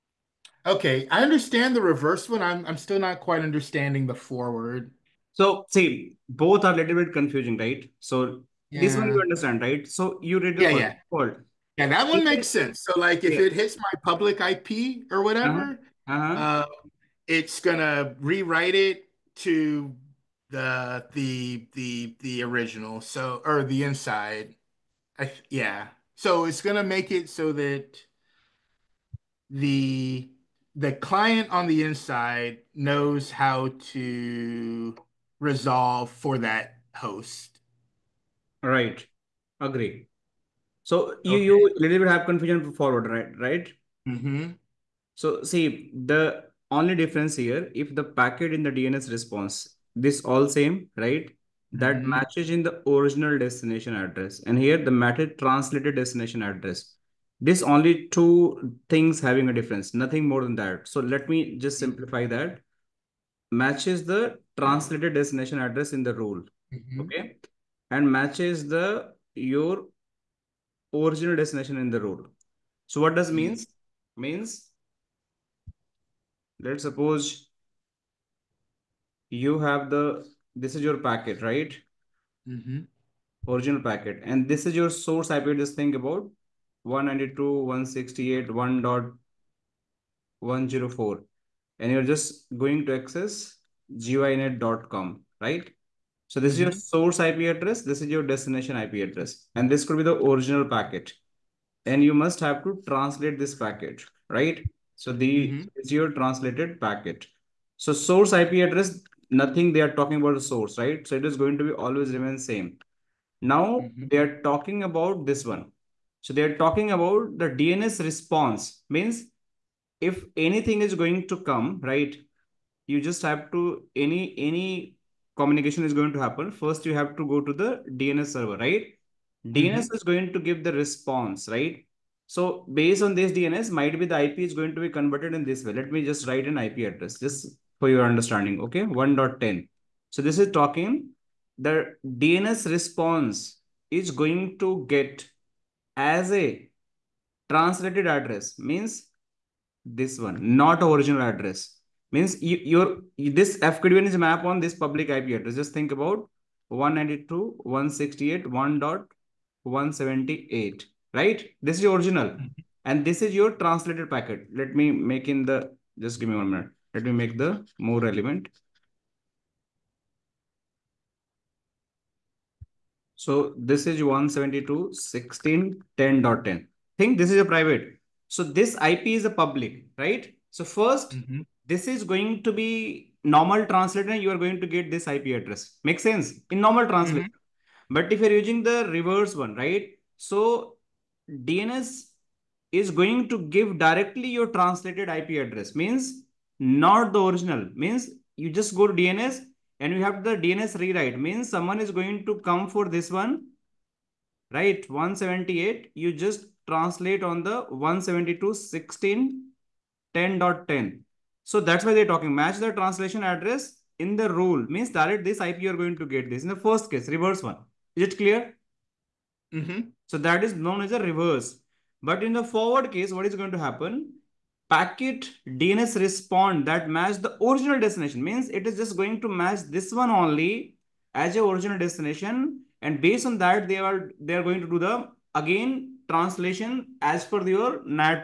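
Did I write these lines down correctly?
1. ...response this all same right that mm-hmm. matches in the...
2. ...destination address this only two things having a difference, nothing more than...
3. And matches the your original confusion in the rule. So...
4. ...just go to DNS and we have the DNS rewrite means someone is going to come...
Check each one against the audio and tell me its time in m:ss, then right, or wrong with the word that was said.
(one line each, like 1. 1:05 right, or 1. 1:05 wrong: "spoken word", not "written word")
1. 0:49 right
2. 0:55 right
3. 1:07 wrong: "destination", not "confusion"
4. 3:18 right.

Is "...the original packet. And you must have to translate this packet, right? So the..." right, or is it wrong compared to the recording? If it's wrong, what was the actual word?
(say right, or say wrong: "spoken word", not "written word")
right.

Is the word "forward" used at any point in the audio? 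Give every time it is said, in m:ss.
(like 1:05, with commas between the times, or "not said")
0:04, 0:11, 0:42, 3:42.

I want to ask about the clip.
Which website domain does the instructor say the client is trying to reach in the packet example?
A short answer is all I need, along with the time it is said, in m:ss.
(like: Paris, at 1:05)
guinet.com, at 1:33.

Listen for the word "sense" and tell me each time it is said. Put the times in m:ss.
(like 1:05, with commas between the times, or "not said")
0:12, 3:06.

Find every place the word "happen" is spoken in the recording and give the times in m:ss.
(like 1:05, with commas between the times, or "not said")
2:06, 3:43.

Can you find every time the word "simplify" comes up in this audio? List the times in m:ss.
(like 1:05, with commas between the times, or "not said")
1:01.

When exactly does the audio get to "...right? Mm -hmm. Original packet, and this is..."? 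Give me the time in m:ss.
1:21.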